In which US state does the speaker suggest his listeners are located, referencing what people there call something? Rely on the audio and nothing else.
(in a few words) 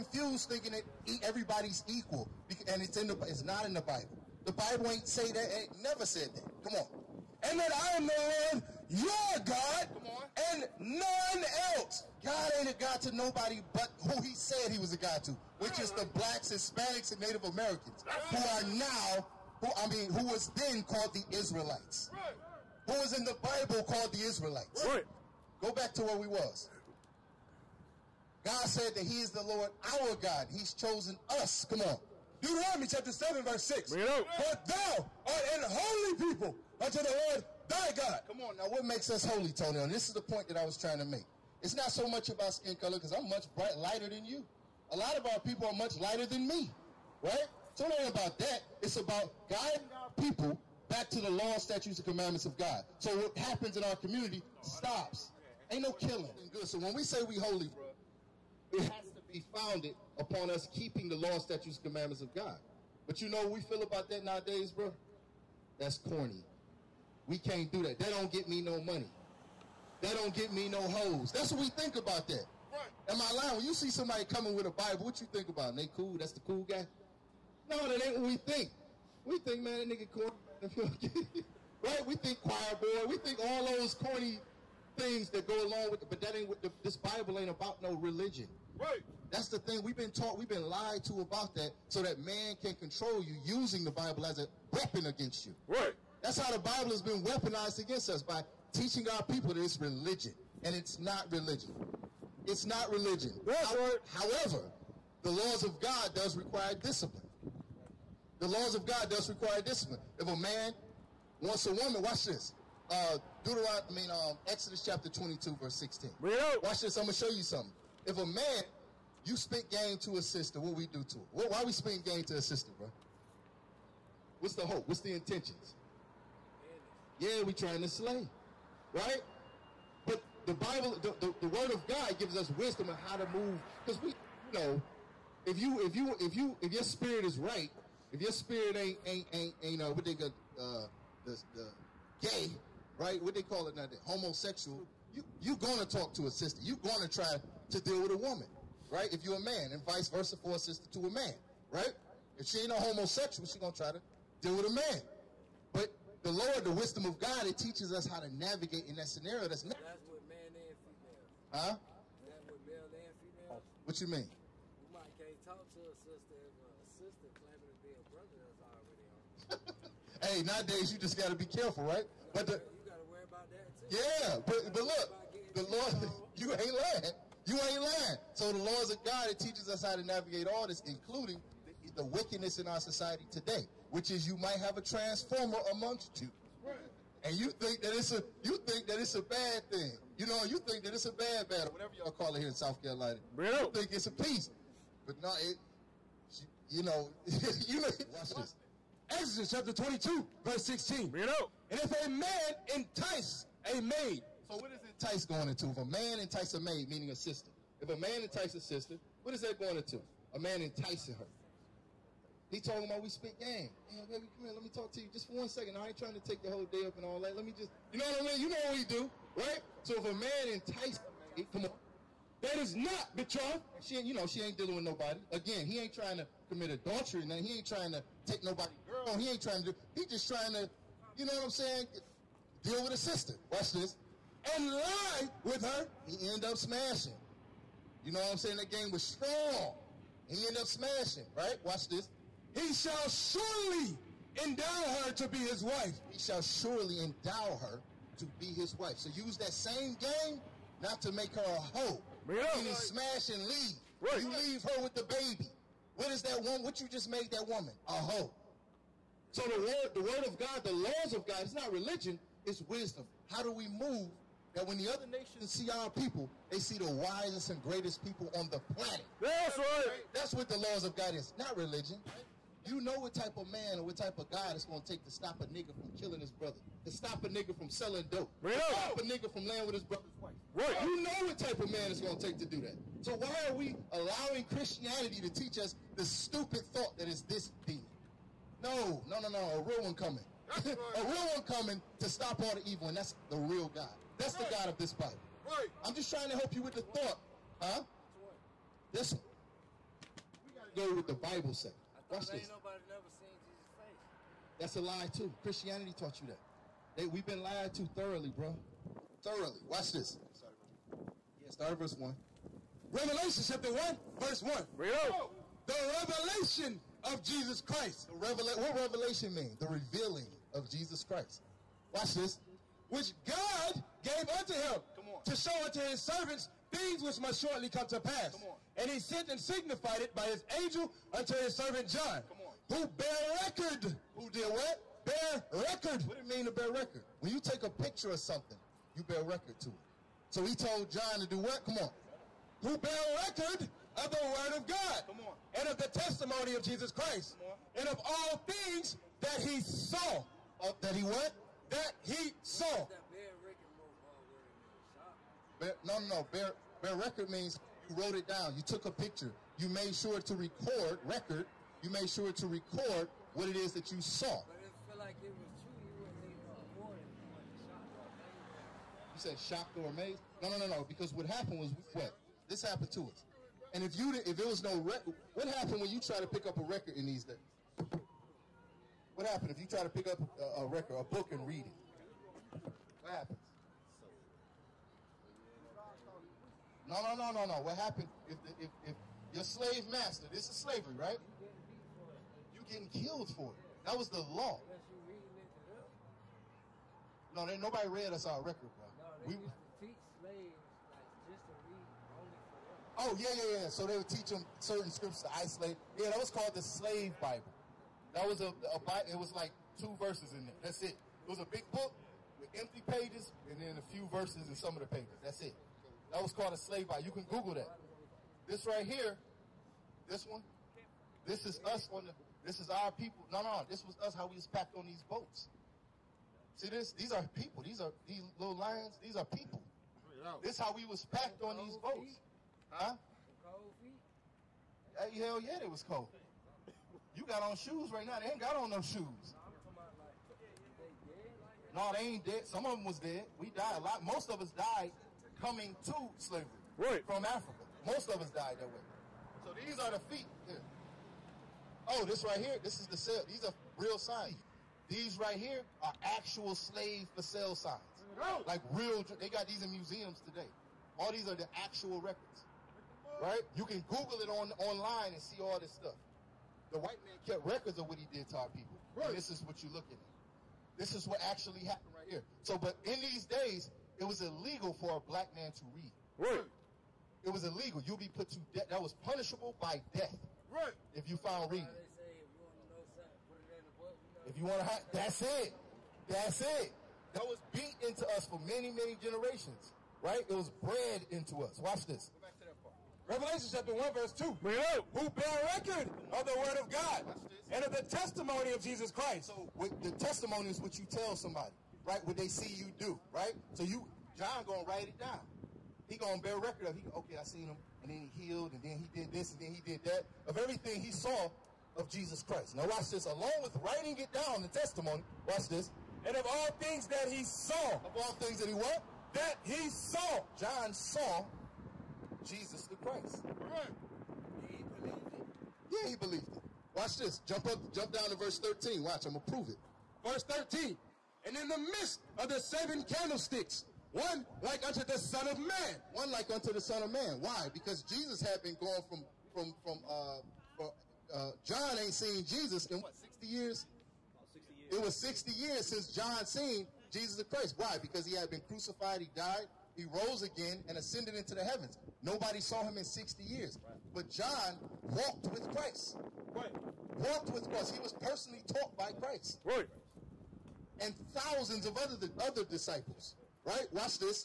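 South Carolina.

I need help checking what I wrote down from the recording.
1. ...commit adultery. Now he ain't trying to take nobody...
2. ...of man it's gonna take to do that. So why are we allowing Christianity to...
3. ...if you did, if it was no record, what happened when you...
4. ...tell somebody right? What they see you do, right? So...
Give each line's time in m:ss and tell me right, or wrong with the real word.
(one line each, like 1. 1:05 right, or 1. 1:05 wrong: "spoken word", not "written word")
1. 3:46 right
2. 4:41 right
3. 6:13 right
4. 8:20 right.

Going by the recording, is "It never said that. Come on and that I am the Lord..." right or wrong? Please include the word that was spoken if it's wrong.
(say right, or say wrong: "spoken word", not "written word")
right.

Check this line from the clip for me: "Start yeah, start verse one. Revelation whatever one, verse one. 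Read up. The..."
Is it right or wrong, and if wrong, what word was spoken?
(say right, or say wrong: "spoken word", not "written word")
wrong: "chapter", not "whatever".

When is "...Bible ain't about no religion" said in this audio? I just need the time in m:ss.
1:26.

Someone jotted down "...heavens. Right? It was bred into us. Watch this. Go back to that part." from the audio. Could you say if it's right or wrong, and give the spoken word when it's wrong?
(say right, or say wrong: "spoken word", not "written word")
wrong: "generations", not "heavens".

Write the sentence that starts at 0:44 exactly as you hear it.
A lot of our people are much lighter than me, right?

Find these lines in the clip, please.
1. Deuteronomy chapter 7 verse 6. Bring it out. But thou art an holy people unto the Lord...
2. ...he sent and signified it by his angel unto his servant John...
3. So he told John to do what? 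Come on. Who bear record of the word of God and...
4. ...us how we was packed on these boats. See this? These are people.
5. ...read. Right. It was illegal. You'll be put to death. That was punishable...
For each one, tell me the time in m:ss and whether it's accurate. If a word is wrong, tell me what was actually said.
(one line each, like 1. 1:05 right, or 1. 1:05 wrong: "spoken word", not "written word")
1. 0:32 right
2. 5:28 right
3. 5:40 right
4. 7:03 right
5. 7:55 right.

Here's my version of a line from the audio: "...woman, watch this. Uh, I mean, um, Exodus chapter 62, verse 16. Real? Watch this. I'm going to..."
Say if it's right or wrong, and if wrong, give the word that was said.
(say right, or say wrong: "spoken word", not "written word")
wrong: "22", not "62".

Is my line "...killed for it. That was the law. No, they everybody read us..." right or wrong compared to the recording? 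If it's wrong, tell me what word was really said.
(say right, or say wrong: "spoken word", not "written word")
wrong: "nobody", not "everybody".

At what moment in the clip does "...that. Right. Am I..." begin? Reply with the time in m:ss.
1:12.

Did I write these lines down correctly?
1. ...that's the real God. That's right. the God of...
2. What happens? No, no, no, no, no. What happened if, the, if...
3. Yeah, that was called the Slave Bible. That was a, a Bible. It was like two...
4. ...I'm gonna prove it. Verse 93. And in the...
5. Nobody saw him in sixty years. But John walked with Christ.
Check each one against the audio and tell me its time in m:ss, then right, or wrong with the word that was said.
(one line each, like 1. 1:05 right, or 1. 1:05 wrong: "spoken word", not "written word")
1. 4:52 right
2. 6:23 right
3. 6:45 right
4. 8:49 wrong: "13", not "93"
5. 9:12 right.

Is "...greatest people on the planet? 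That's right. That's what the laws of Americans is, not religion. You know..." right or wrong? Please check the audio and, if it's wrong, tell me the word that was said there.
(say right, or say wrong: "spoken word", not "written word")
wrong: "God", not "Americans".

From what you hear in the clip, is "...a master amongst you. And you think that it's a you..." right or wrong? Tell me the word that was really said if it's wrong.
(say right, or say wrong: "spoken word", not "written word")
wrong: "transformer", not "master".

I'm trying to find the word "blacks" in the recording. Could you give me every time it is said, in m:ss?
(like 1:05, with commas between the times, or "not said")
0:16, 7:55.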